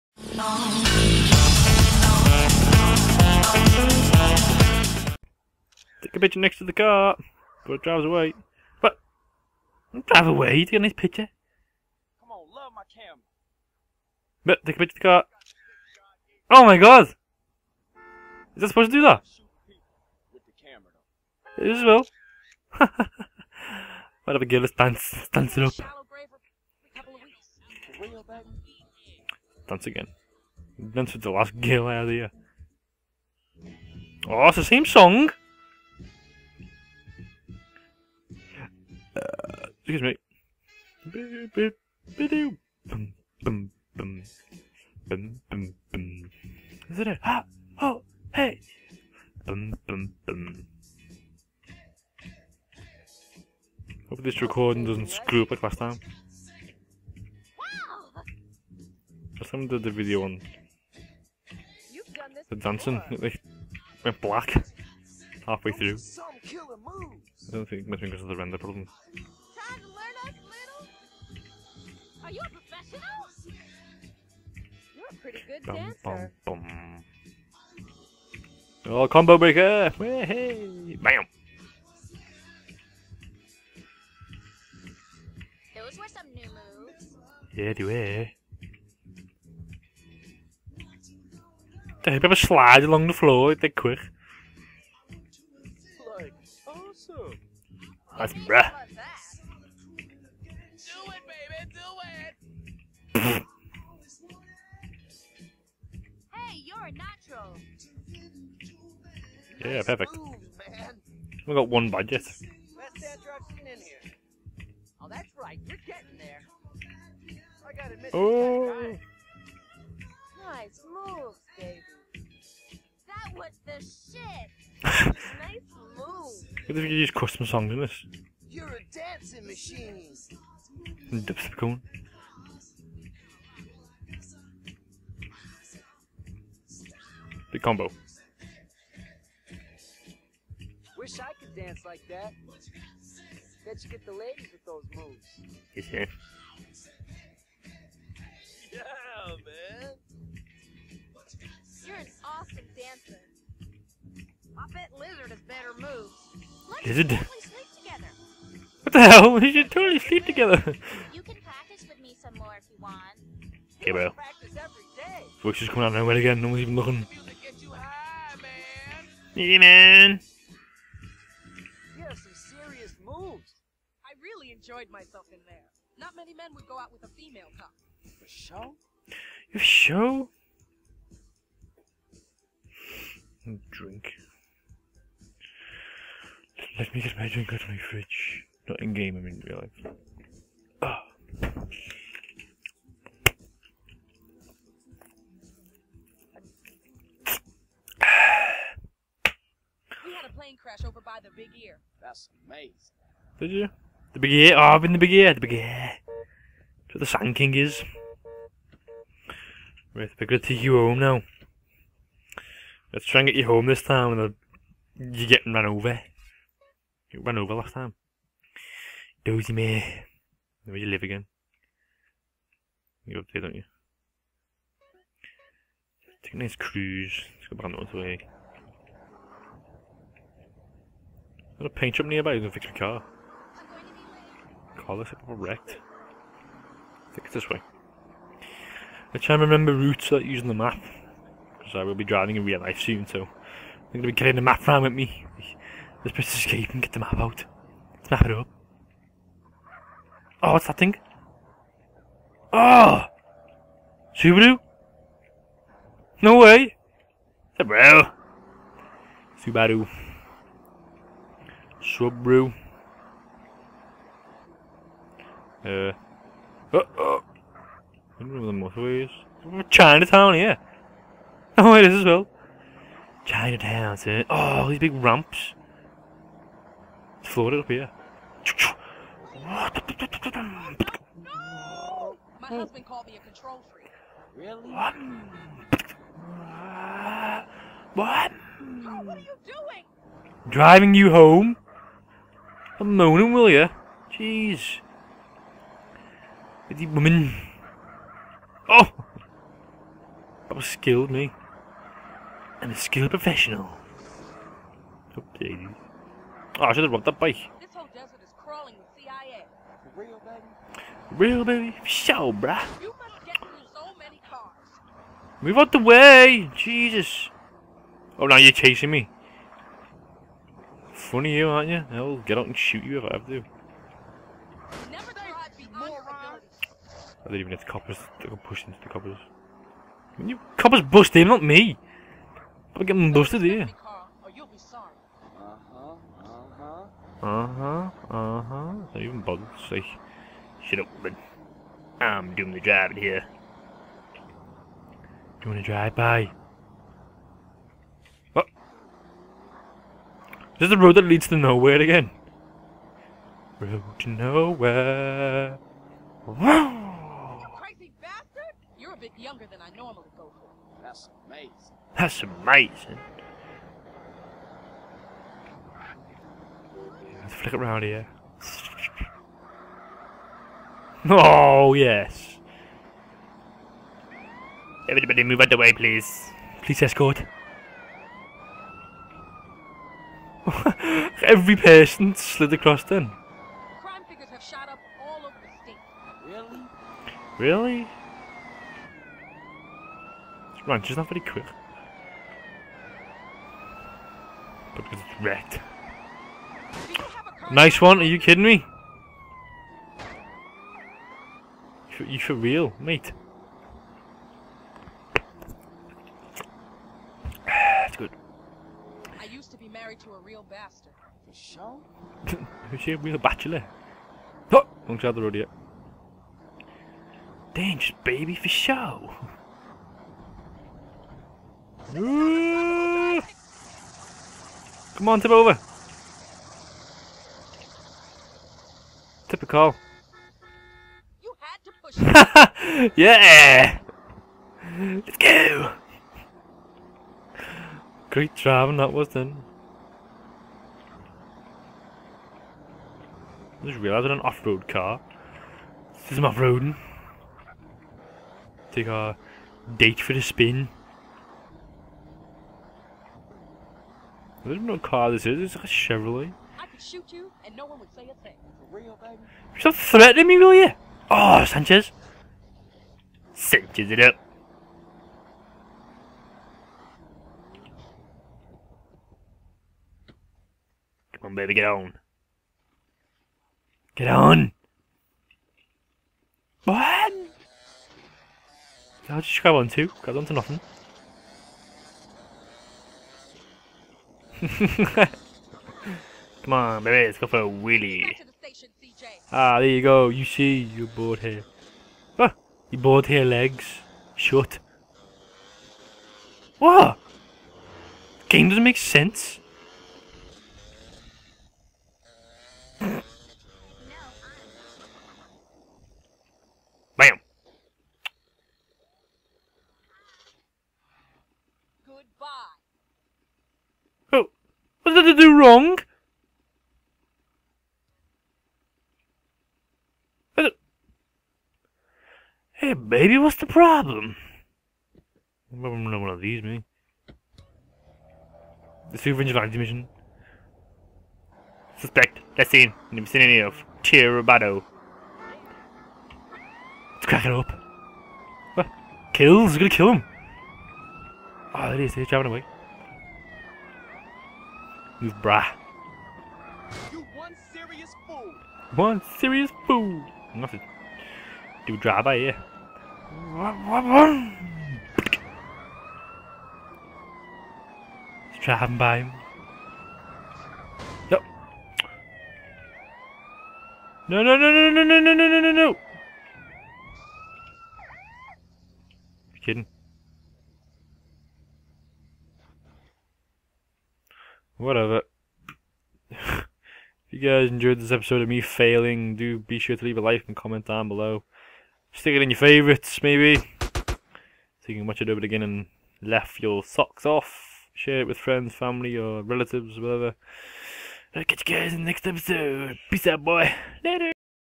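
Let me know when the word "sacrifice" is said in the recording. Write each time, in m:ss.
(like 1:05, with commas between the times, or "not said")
not said.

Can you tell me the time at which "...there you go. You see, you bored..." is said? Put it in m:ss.
8:09.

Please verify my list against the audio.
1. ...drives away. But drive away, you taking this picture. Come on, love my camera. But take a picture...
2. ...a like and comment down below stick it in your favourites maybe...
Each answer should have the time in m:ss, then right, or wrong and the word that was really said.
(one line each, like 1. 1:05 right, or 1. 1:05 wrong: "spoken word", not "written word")
1. 0:07 right
2. 9:39 right.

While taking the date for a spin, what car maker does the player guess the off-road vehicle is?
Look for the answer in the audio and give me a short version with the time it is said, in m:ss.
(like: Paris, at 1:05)
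Chevrolet, at 7:35.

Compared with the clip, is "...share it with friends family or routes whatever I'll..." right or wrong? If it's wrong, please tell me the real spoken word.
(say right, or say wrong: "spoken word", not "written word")
wrong: "relatives", not "routes".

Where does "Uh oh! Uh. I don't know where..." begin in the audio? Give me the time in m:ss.
4:25.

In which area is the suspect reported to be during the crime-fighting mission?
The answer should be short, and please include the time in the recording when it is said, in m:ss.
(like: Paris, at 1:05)
Tierra Robada, at 8:53.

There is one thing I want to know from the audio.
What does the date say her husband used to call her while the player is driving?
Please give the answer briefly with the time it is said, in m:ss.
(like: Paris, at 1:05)
A control freak, at 4:43.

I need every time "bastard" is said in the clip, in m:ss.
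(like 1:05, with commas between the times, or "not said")
5:58, 6:50.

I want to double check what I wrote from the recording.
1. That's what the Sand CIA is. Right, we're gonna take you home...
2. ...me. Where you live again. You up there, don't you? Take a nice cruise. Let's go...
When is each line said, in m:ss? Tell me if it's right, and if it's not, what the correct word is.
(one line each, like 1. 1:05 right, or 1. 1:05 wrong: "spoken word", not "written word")
1. 3:26 wrong: "King", not "CIA"
2. 3:39 right.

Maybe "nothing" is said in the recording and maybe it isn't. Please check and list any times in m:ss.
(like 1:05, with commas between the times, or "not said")
8:00, 9:10.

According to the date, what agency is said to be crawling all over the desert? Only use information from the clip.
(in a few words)
CIA.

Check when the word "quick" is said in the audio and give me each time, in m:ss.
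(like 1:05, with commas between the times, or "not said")
1:33, 6:31.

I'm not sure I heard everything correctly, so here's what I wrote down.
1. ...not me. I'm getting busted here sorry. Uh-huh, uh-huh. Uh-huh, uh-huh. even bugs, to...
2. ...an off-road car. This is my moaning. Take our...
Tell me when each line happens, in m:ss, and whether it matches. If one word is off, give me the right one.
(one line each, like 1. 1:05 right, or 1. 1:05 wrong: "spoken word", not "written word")
1. 5:31 right
2. 7:24 wrong: "roading", not "moaning".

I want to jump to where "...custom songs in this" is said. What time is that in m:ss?
2:07.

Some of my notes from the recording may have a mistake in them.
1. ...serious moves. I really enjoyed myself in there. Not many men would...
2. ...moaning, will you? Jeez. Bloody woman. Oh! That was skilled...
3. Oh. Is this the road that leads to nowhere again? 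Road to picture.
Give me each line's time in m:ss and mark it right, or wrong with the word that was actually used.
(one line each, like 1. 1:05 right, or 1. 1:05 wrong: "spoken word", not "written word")
1. 2:52 right
2. 4:52 right
3. 5:48 wrong: "nowhere", not "picture".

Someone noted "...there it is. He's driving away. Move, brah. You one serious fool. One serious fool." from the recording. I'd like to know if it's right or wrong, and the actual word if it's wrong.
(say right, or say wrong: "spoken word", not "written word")
right.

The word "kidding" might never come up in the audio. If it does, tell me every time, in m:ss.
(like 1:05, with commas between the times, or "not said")
6:38, 9:29.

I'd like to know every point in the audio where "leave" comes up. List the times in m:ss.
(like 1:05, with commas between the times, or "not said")
9:39.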